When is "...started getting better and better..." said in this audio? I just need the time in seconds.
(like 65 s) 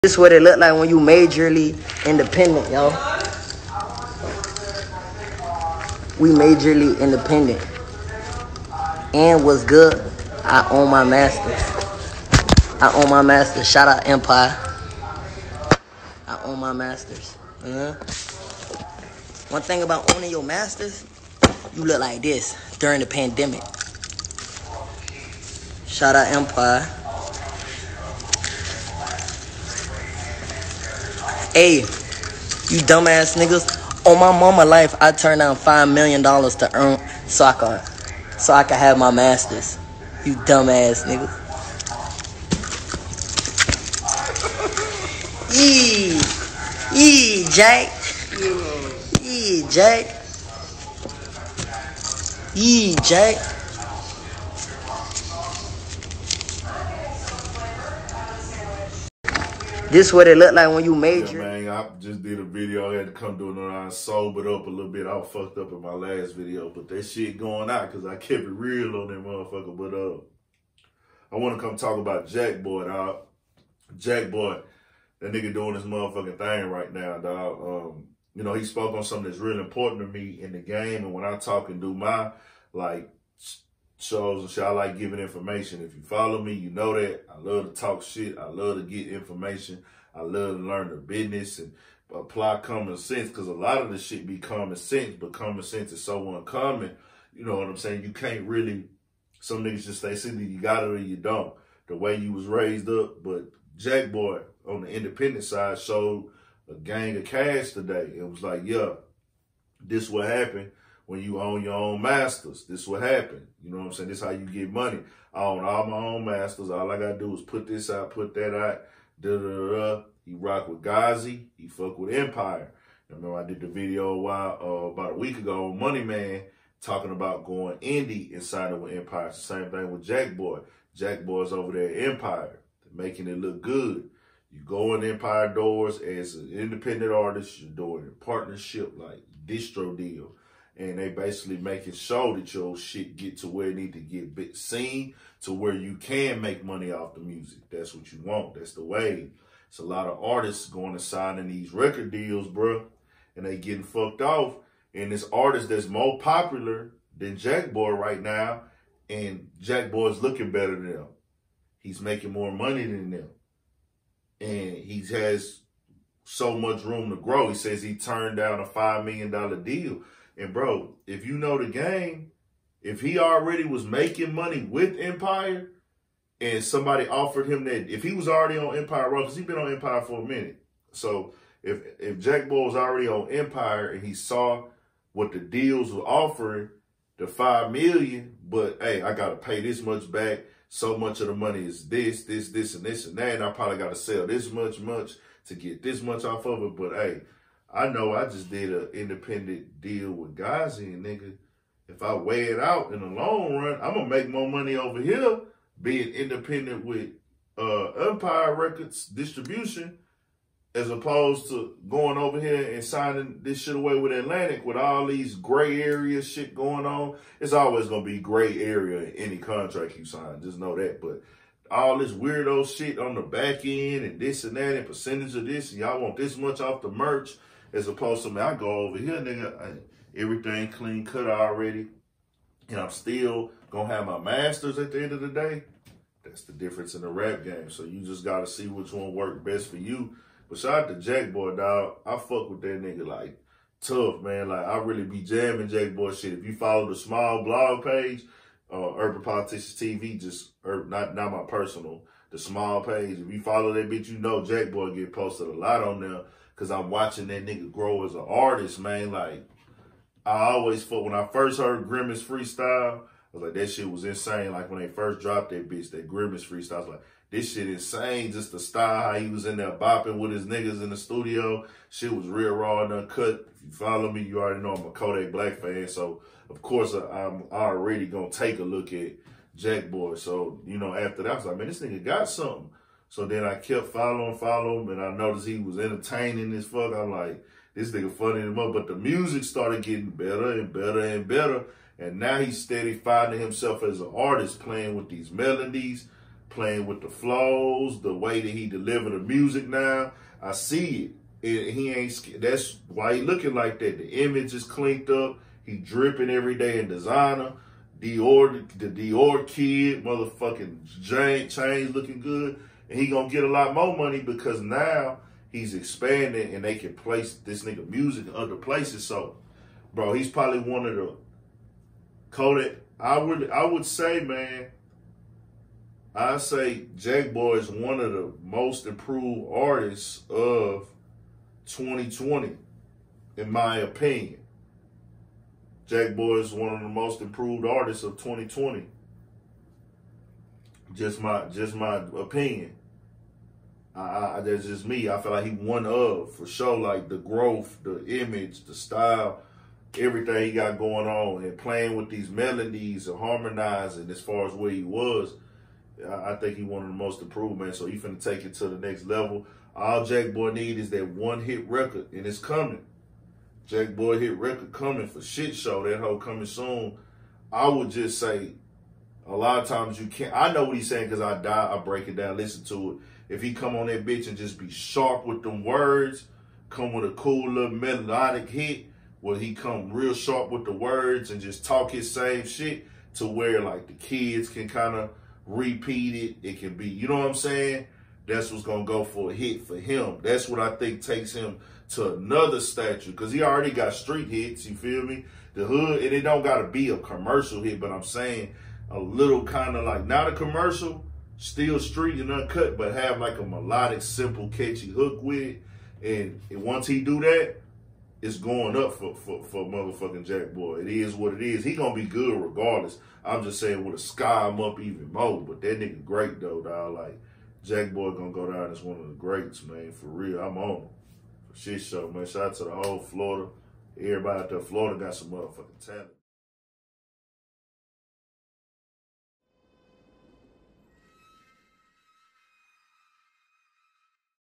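289 s.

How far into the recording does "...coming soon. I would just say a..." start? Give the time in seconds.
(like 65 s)
366 s.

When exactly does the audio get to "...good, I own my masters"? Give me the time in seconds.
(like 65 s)
9 s.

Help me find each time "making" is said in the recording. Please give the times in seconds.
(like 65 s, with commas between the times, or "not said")
133 s, 141 s, 162 s, 173 s.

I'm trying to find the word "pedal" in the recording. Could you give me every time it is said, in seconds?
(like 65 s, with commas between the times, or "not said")
not said.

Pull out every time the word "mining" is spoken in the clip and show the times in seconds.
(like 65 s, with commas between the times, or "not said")
not said.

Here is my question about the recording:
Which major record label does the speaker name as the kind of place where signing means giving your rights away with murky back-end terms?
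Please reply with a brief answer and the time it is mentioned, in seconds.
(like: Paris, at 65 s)
Atlantic, at 214 s.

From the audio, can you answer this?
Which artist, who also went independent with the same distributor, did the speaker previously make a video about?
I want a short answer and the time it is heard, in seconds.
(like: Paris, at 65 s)
Money Man, at 125 s.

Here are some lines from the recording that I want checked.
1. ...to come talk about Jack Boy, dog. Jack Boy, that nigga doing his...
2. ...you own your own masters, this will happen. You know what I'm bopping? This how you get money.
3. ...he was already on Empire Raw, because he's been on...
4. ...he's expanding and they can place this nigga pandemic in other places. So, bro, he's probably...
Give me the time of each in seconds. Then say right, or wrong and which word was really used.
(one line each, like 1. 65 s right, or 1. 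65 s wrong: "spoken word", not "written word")
1. 71 s right
2. 111 s wrong: "saying", not "bopping"
3. 178 s right
4. 315 s wrong: "music", not "pandemic".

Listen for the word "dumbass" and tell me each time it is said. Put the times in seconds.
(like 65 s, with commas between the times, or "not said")
32 s, 40 s.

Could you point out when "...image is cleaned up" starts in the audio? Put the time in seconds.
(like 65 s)
304 s.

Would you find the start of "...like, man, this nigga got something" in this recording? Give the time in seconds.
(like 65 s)
281 s.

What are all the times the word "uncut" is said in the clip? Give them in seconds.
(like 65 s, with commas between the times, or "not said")
272 s, 402 s.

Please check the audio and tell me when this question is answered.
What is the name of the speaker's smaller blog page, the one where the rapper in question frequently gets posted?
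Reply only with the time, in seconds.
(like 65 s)
248 s.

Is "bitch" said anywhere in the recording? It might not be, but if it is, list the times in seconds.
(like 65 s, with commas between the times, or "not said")
253 s, 265 s, 374 s.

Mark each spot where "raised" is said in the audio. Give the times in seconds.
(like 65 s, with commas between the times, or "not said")
102 s.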